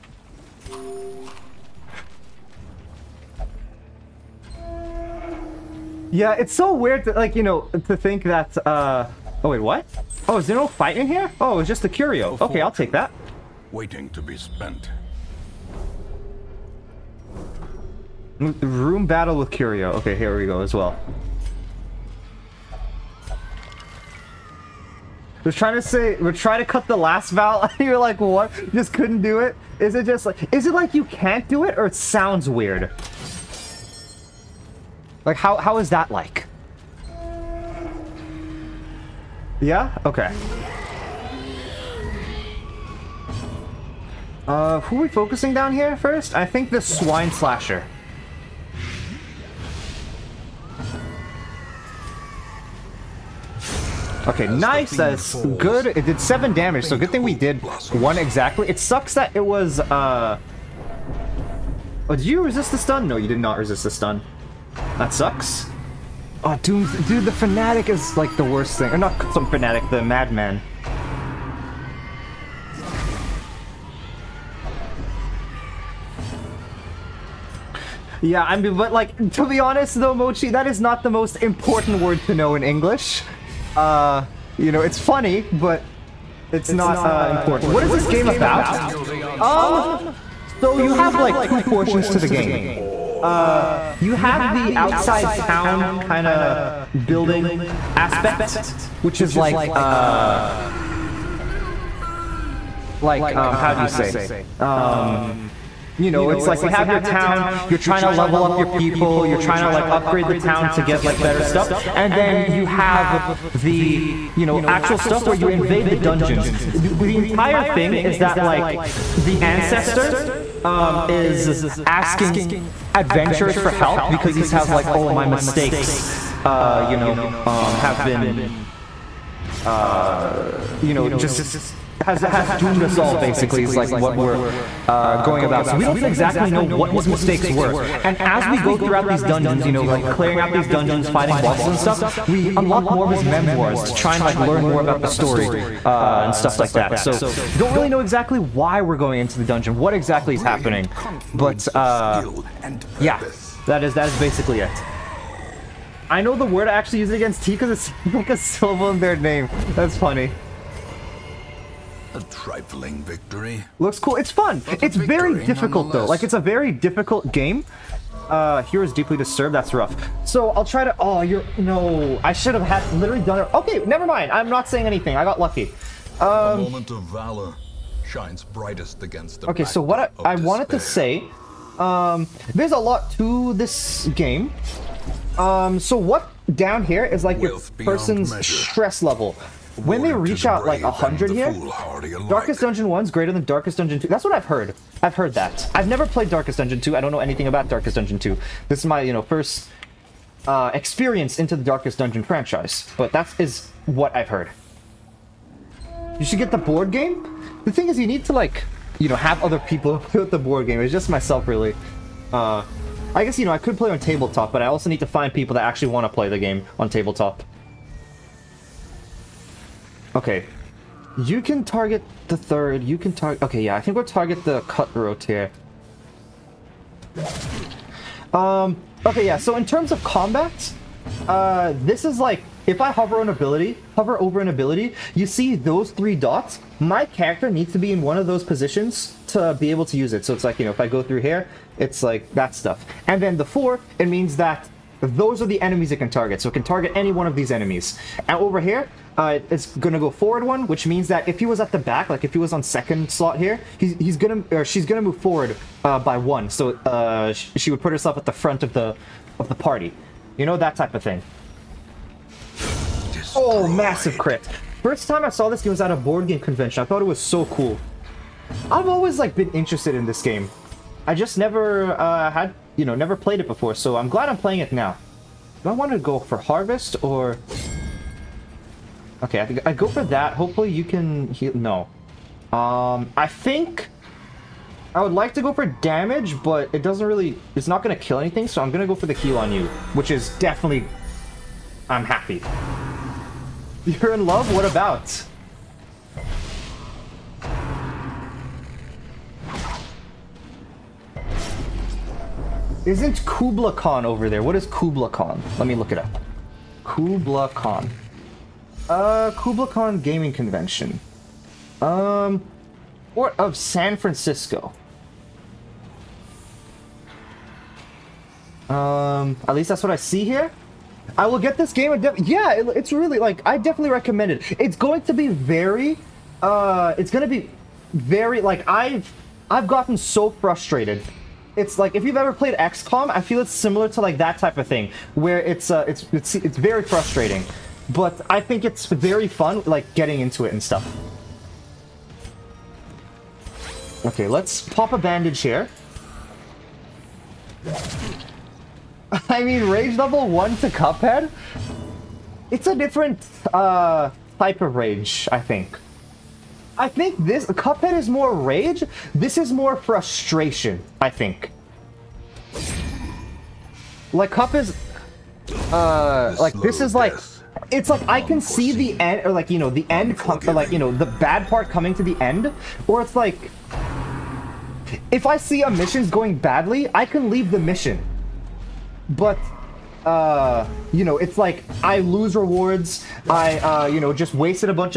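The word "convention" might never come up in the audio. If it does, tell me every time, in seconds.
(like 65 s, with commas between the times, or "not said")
266 s, 310 s.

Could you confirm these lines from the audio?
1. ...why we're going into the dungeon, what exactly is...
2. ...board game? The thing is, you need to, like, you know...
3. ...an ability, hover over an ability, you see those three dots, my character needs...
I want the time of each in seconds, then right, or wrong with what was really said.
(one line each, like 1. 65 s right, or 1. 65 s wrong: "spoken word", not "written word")
1. 148 s right
2. 206 s right
3. 233 s right.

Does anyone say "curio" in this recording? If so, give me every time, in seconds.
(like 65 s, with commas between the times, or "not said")
11 s, 19 s.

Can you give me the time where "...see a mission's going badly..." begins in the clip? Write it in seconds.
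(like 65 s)
375 s.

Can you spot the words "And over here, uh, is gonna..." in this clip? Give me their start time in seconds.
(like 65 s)
248 s.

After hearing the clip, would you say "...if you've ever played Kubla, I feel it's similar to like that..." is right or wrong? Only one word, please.
wrong.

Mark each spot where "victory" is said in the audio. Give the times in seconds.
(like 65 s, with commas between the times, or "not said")
163 s.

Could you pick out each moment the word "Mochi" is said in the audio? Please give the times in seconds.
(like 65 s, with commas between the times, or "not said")
80 s.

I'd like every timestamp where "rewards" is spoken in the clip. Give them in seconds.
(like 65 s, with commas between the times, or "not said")
382 s.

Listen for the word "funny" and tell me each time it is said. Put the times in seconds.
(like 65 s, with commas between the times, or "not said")
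84 s, 159 s.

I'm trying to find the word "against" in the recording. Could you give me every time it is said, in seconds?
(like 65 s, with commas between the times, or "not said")
157 s, 179 s.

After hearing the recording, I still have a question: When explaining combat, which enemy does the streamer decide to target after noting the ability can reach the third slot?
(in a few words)
The cutthroat.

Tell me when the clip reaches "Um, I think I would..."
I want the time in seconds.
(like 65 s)
282 s.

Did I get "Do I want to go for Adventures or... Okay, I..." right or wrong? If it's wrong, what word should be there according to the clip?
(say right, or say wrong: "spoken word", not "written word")
wrong: "Harvest", not "Adventures".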